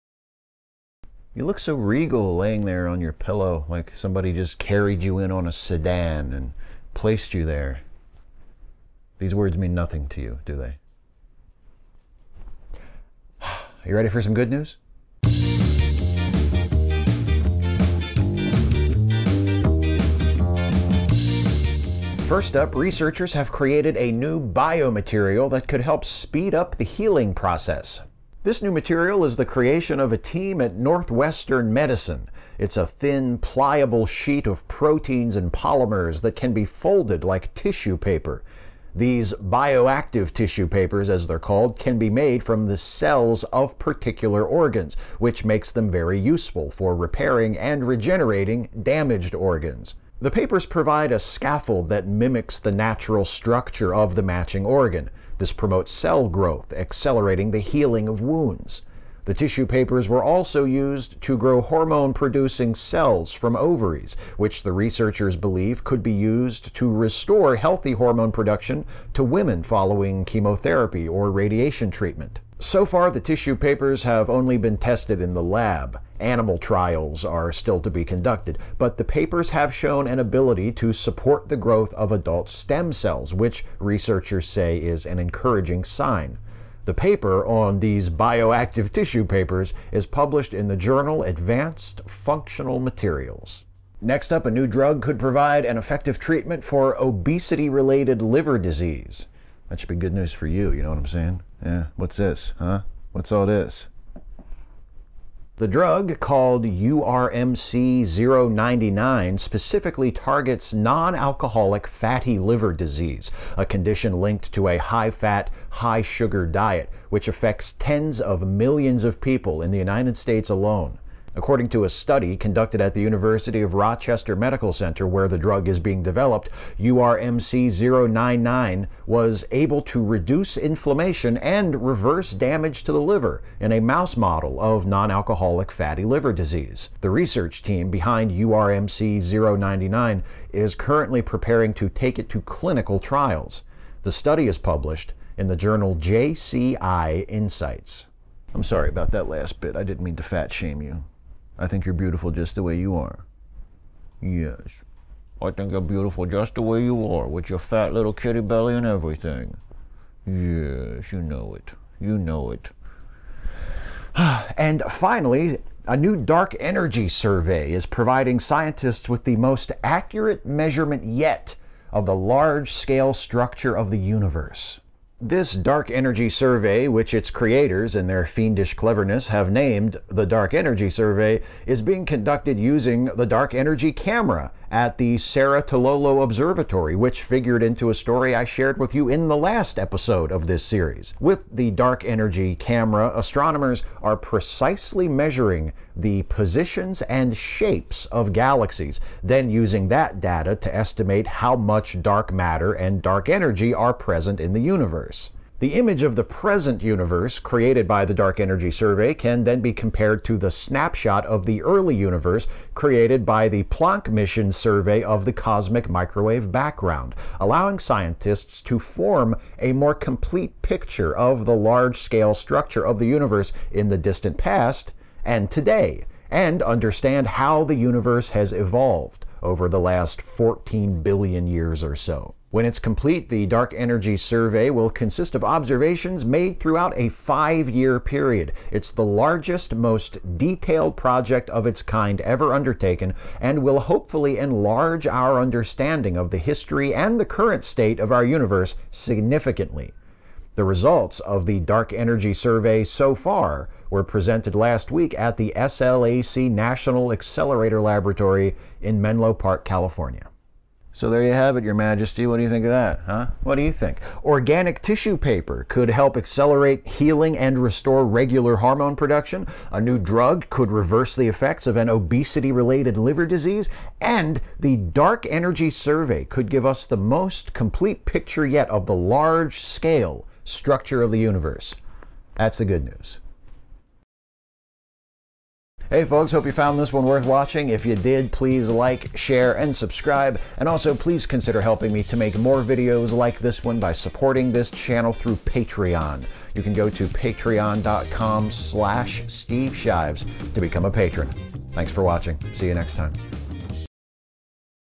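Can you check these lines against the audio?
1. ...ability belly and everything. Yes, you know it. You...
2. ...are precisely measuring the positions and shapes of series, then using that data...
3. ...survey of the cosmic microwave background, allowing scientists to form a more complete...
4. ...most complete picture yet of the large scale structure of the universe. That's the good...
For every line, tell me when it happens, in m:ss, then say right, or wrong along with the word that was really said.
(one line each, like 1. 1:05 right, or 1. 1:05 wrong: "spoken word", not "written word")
1. 2:38 wrong: "kitty", not "ability"
2. 3:14 wrong: "galaxies", not "series"
3. 3:34 right
4. 4:36 right.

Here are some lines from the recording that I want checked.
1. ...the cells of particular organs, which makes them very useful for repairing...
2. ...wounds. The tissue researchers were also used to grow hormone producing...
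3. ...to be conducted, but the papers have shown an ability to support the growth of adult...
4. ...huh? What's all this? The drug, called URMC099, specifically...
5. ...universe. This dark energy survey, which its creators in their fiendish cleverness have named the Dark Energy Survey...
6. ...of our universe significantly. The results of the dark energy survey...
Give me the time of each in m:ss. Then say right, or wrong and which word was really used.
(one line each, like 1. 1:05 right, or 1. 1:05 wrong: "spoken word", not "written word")
1. 0:42 right
2. 0:58 wrong: "papers", not "researchers"
3. 1:17 right
4. 1:42 right
5. 2:53 right
6. 4:08 right.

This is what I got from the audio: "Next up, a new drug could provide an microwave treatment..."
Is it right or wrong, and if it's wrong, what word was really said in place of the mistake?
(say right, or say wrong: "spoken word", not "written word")
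wrong: "effective", not "microwave".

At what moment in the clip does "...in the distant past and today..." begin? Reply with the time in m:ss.
3:43.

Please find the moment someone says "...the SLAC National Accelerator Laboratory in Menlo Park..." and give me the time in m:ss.
4:15.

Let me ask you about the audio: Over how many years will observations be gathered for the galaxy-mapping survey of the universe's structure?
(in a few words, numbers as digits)
5 years.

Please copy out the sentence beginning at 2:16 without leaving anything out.
The research team behind URMC099 is currently preparing to take it to clinical trials.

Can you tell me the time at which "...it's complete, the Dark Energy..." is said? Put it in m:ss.
3:52.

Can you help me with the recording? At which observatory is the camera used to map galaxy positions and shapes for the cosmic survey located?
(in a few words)
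Cerro Tololo Observatory.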